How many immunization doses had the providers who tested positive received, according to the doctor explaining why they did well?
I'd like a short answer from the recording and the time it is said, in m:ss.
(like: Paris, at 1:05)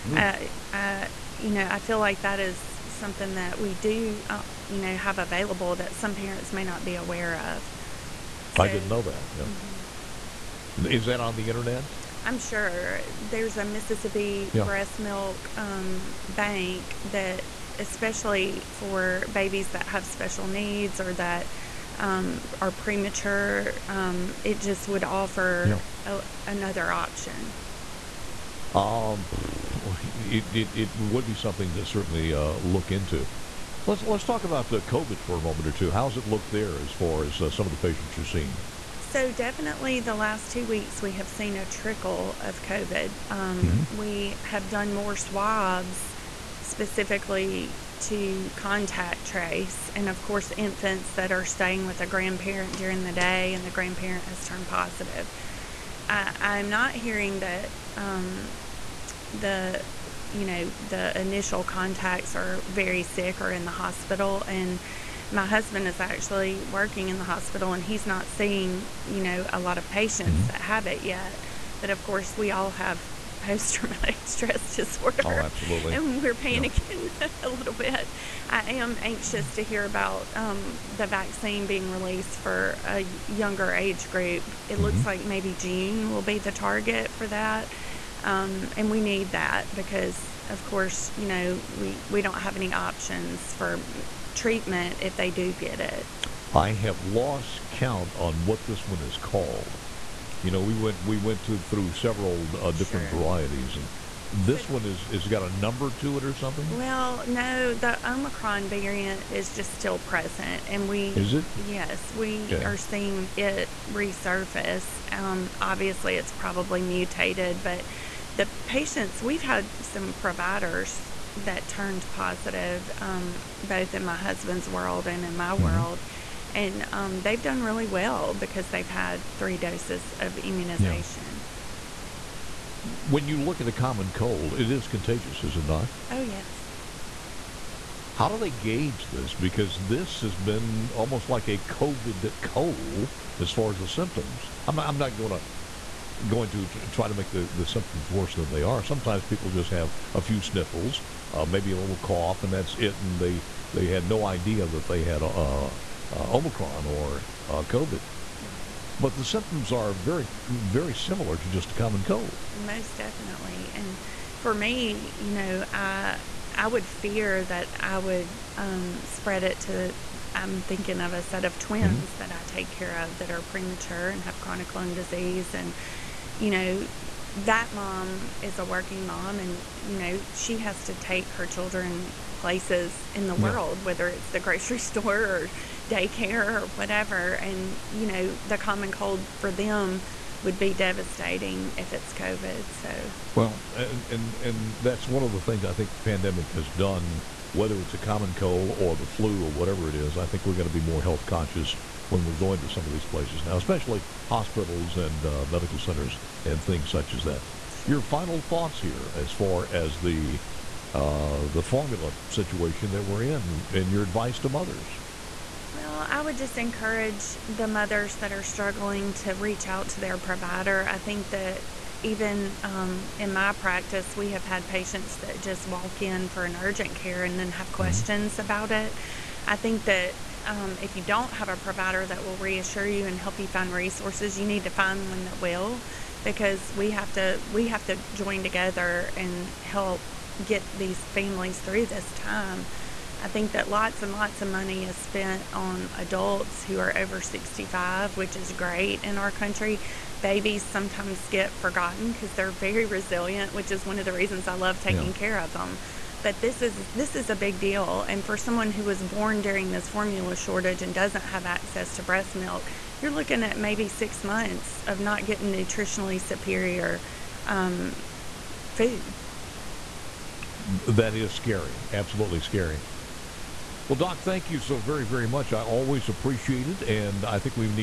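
3, at 2:09.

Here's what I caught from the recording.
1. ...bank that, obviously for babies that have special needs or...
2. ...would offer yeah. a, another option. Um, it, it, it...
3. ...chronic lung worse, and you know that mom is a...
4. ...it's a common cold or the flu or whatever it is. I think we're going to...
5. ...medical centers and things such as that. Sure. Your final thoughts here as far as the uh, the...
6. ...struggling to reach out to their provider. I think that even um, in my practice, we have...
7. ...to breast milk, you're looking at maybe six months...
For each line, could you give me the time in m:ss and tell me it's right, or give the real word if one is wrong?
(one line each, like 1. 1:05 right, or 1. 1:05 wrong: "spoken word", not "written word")
1. 0:16 wrong: "especially", not "obviously"
2. 0:24 right
3. 2:54 wrong: "disease", not "worse"
4. 3:17 right
5. 3:25 right
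6. 3:38 right
7. 4:21 right.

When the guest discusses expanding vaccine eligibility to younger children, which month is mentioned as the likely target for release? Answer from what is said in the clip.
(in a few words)
June.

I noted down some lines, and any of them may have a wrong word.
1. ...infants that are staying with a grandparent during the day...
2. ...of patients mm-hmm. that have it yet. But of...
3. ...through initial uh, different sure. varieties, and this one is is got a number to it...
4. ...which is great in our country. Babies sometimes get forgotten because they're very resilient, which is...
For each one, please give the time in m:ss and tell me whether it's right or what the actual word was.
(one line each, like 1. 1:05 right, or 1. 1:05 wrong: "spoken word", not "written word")
1. 0:50 right
2. 1:09 right
3. 1:41 wrong: "several", not "initial"
4. 4:08 right.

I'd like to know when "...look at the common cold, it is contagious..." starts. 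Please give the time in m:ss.
2:13.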